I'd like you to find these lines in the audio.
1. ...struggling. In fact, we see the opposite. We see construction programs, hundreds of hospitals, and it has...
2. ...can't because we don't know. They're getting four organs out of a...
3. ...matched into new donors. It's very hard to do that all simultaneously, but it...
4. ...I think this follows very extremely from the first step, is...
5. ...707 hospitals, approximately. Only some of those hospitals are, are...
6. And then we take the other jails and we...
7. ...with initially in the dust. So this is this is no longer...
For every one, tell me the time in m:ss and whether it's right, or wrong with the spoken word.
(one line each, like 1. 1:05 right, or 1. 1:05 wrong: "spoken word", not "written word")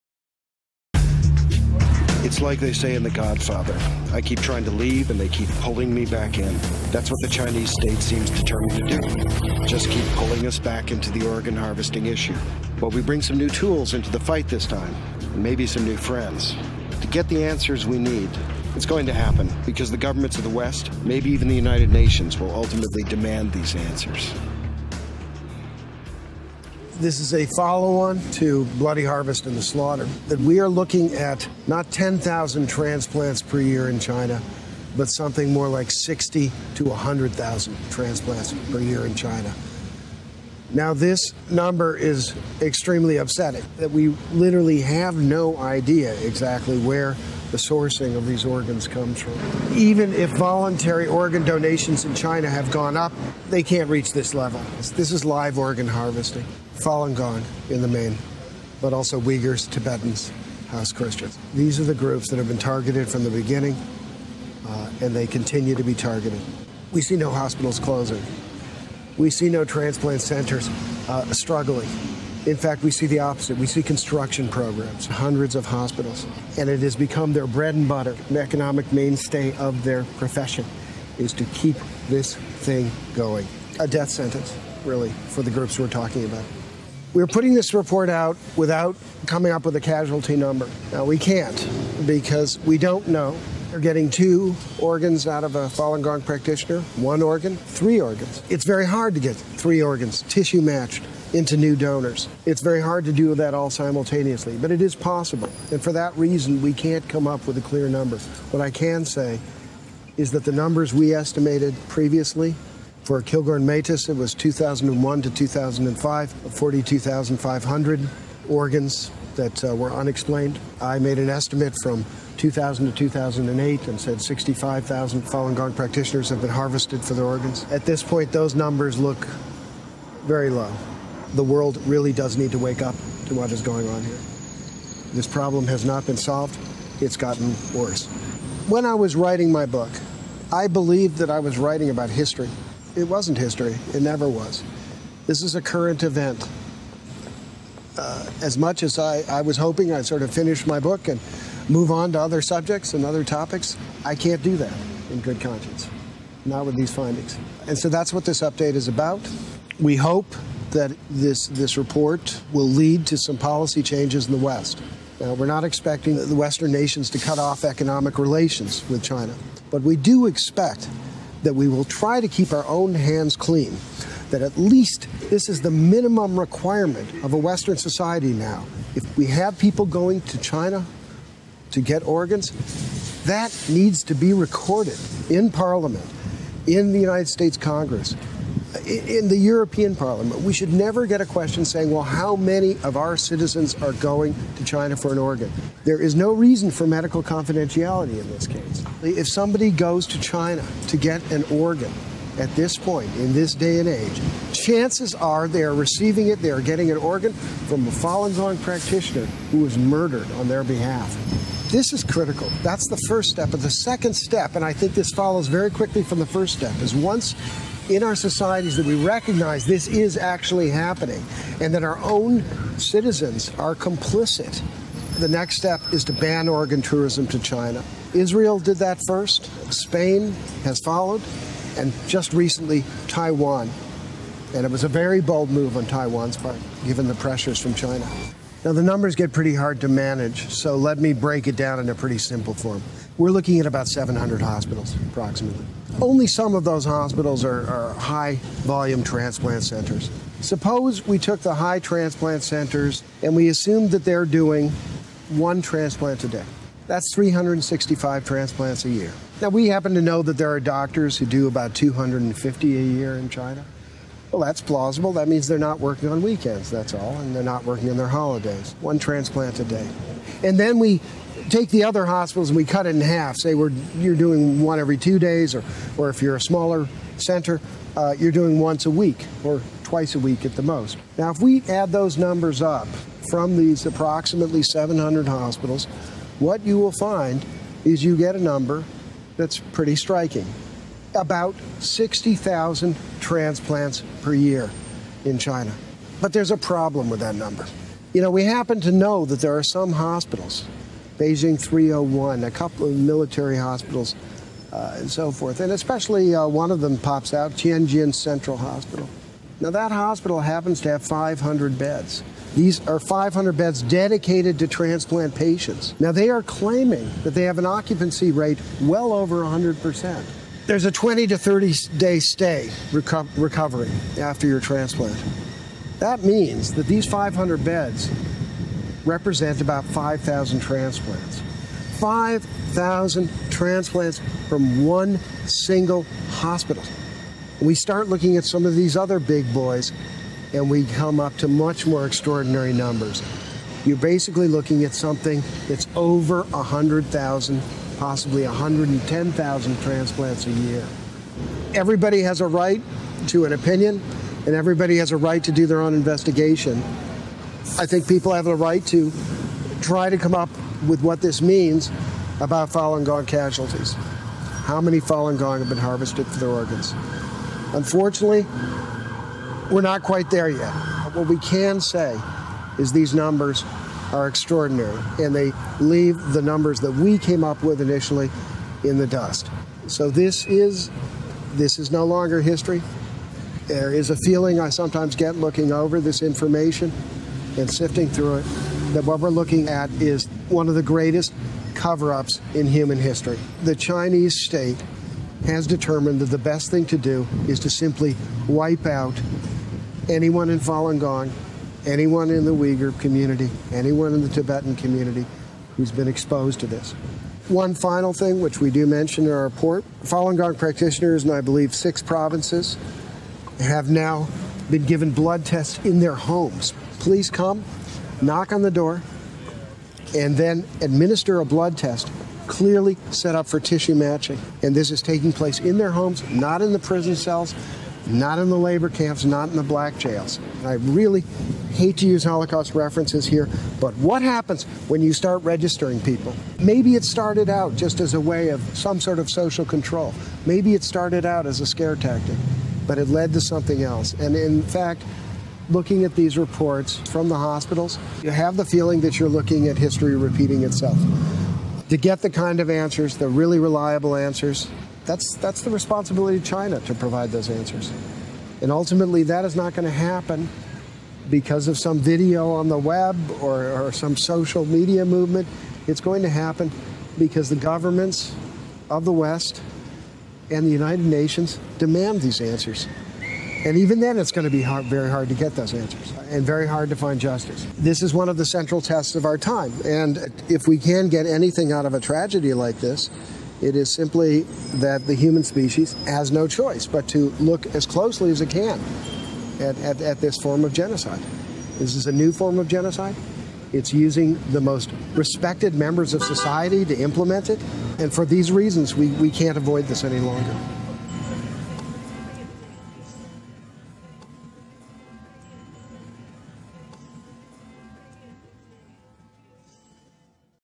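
1. 1:11 right
2. 1:31 wrong: "two", not "four"
3. 1:40 right
4. 3:34 wrong: "quickly", not "extremely"
5. 4:03 wrong: "700", not "707"
6. 4:30 wrong: "hospitals", not "jails"
7. 6:17 right.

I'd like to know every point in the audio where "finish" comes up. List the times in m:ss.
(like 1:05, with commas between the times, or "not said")
2:30.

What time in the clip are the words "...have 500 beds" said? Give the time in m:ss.
5:10.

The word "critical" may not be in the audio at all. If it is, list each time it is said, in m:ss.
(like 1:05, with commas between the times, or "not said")
3:32.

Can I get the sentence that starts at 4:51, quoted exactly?
About 60,000 transplants per year in China.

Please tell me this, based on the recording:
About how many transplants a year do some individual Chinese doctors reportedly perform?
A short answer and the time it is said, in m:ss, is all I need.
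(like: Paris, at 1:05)
250, at 4:21.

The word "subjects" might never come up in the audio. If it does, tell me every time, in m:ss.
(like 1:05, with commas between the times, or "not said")
2:32.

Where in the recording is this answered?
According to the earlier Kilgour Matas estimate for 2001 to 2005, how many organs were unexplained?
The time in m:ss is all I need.
1:56.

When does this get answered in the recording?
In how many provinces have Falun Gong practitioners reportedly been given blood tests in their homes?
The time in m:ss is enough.
6:51.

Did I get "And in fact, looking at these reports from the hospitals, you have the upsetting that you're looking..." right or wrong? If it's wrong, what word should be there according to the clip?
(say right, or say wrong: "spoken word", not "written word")
wrong: "feeling", not "upsetting".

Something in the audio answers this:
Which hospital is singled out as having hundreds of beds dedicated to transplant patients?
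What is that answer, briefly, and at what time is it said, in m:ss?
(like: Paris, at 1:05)
Tianjin Central Hospital, at 5:07.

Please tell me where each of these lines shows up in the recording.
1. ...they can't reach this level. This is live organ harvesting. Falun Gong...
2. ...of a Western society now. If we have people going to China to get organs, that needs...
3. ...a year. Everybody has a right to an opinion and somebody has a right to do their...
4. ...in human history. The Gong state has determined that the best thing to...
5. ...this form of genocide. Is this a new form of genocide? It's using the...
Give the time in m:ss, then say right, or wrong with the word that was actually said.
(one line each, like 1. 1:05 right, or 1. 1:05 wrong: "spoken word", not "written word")
1. 0:53 right
2. 2:57 right
3. 5:50 wrong: "everybody", not "somebody"
4. 6:32 wrong: "Chinese", not "Gong"
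5. 8:10 right.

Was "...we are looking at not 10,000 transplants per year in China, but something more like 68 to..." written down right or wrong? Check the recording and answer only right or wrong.
wrong.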